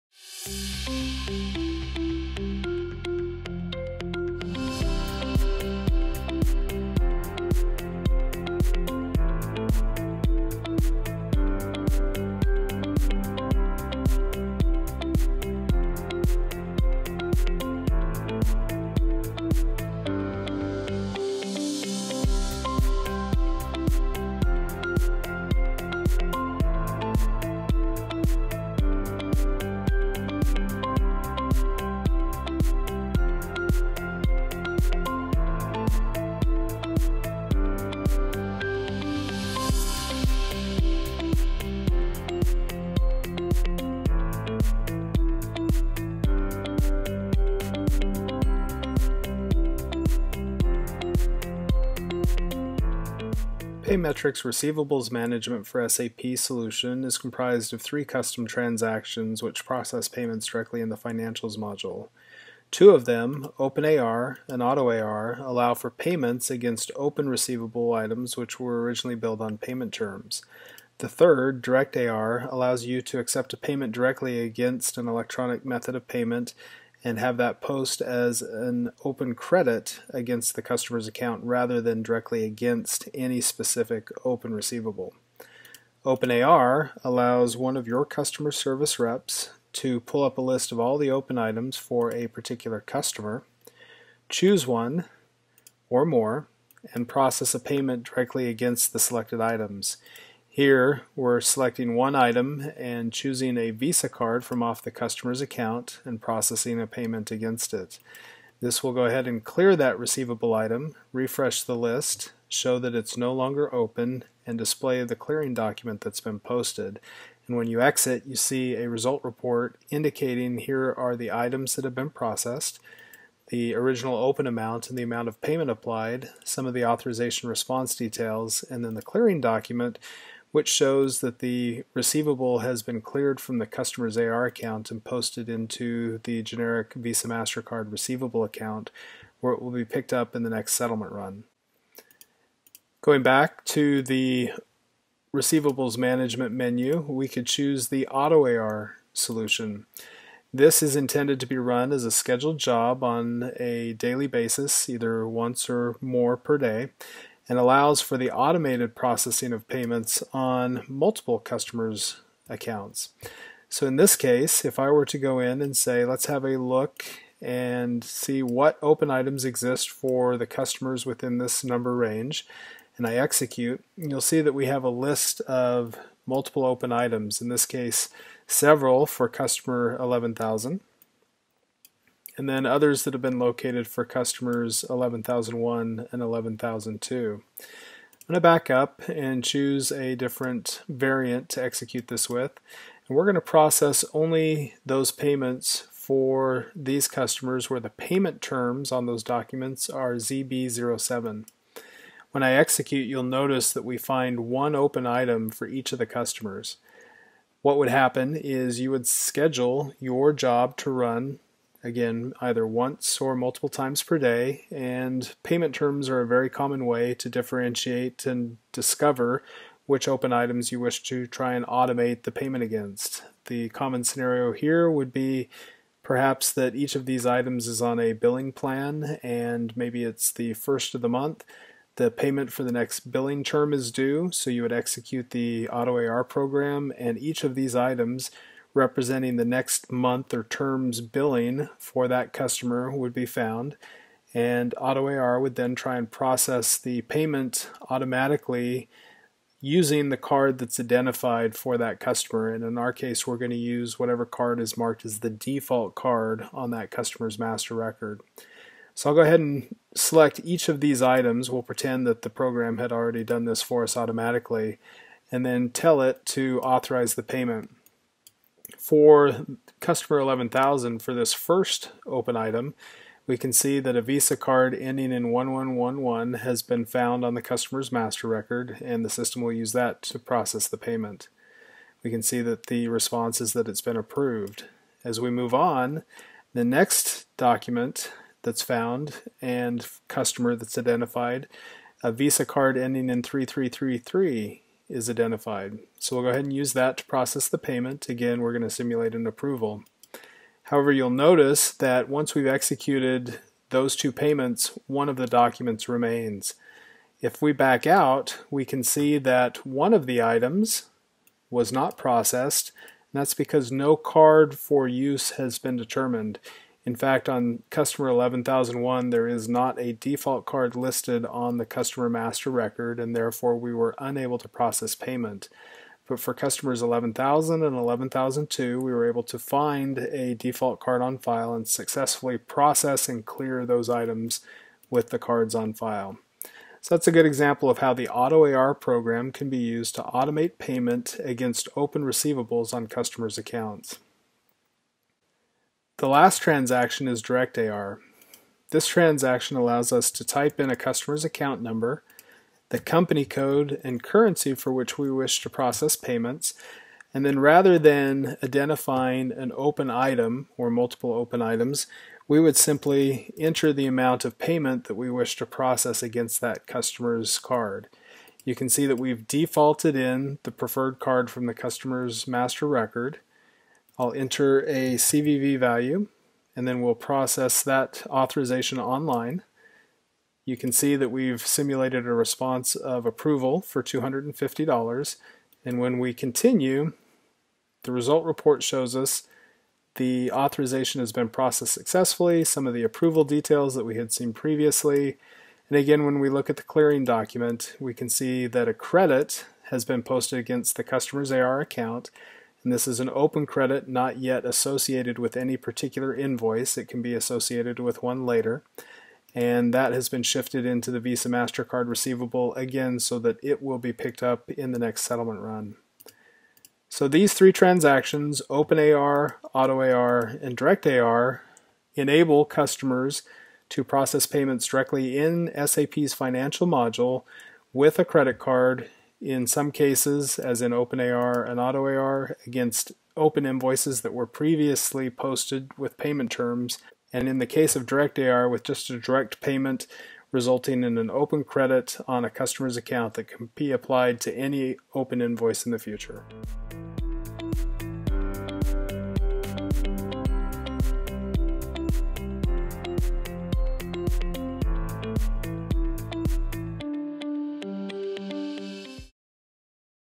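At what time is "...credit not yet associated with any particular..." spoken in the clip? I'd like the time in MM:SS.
06:43.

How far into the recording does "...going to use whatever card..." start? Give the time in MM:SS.
04:13.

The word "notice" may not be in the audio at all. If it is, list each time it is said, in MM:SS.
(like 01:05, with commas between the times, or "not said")
03:23, 05:01.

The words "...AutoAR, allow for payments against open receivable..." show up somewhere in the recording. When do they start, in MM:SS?
01:04.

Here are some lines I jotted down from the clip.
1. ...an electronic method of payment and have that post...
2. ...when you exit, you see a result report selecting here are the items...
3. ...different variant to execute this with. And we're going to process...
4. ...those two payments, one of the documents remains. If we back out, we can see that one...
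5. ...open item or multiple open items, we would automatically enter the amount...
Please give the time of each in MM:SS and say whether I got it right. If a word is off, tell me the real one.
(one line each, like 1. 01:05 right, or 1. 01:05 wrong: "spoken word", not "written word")
1. 01:14 right
2. 01:57 wrong: "indicating", not "selecting"
3. 03:10 right
4. 05:03 right
5. 05:59 wrong: "simply", not "automatically".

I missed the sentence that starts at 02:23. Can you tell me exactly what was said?
Going back to the receivables management menu, we could choose the auto AR solution.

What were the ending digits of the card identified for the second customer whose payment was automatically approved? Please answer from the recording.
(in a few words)
3333.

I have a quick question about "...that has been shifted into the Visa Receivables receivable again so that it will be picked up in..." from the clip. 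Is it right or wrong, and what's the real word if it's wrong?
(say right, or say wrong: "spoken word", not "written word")
wrong: "MasterCard", not "Receivables".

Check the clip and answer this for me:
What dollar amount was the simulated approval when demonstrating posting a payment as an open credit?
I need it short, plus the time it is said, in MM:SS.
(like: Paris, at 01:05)
$250, at 06:23.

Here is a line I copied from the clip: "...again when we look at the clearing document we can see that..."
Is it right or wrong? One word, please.
right.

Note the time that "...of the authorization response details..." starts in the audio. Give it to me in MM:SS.
02:06.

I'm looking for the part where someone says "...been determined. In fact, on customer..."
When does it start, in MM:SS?
05:15.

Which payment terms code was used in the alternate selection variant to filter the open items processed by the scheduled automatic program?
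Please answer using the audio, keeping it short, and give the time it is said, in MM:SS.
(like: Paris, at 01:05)
ZB07, at 03:20.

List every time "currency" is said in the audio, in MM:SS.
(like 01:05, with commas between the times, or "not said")
05:54.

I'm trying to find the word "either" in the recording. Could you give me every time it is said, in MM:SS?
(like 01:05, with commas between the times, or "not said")
02:34, 03:32.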